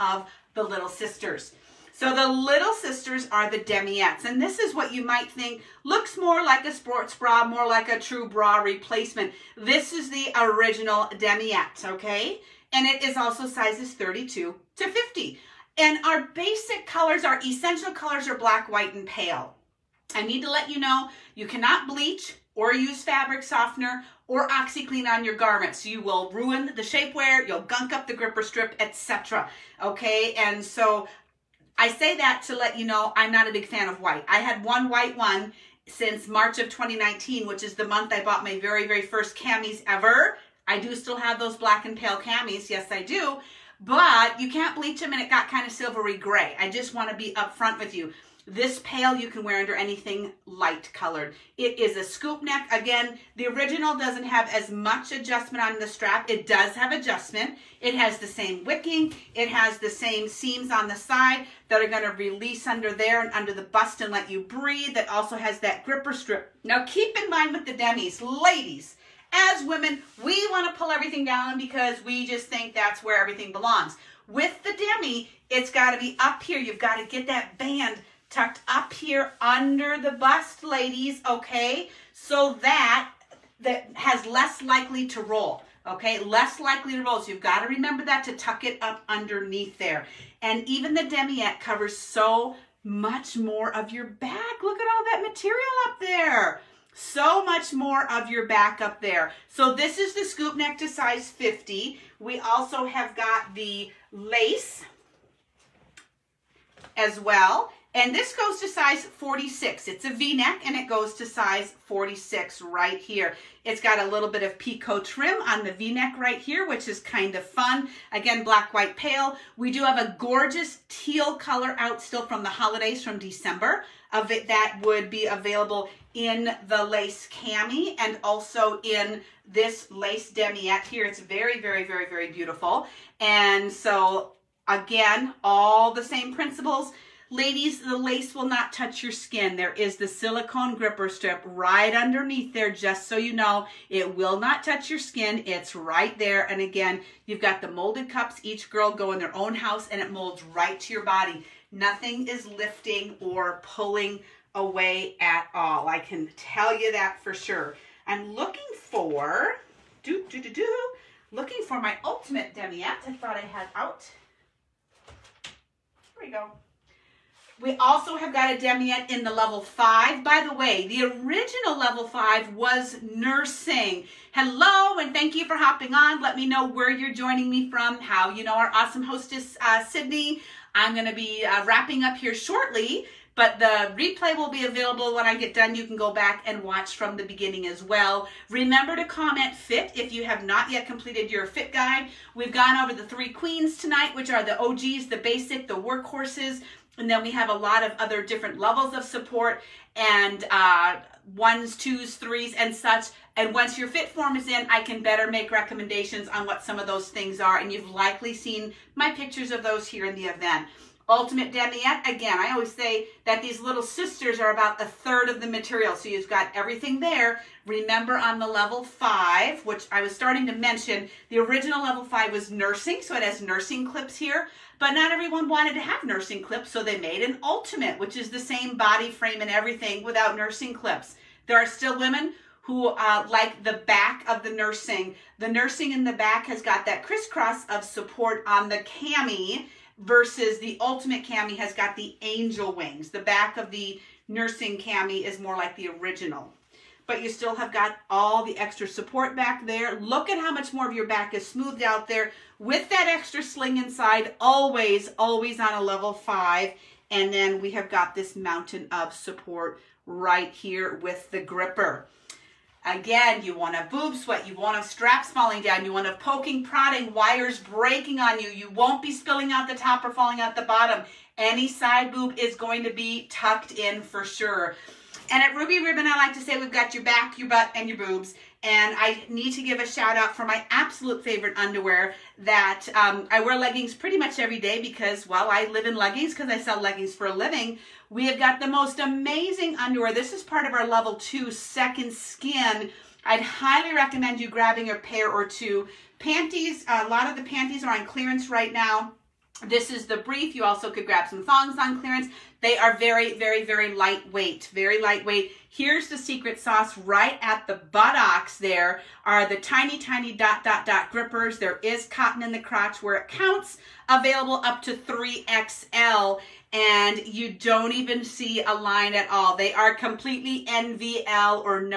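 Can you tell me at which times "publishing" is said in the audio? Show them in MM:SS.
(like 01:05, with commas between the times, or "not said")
not said.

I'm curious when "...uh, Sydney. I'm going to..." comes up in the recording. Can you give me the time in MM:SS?
02:59.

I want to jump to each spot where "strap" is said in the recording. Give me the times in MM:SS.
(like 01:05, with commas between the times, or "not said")
00:55, 04:24.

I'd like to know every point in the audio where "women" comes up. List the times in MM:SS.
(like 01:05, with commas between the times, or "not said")
01:09, 03:51.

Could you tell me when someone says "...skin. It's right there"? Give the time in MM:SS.
02:24.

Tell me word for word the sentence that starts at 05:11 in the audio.
There is cotton in the crotch where it counts, available up to 3XL and you don't even see a line at all.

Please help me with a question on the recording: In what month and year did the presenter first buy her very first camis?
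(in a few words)
March 2019.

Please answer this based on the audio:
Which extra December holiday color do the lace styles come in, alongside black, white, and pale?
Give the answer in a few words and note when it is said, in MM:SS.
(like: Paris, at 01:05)
teal, at 02:00.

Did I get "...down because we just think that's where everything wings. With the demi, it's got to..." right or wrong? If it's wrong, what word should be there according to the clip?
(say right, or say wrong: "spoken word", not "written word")
wrong: "belongs", not "wings".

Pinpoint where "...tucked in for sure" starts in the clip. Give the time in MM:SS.
04:33.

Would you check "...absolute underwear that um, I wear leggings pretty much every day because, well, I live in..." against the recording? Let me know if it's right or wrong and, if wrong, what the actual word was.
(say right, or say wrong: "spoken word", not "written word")
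wrong: "favorite", not "absolute".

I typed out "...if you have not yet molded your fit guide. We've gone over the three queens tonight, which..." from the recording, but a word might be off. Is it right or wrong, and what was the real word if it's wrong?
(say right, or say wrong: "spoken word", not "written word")
wrong: "completed", not "molded".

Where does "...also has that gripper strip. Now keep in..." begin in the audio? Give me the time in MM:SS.
01:05.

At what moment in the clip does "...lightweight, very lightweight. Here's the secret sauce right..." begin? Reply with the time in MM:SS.
05:03.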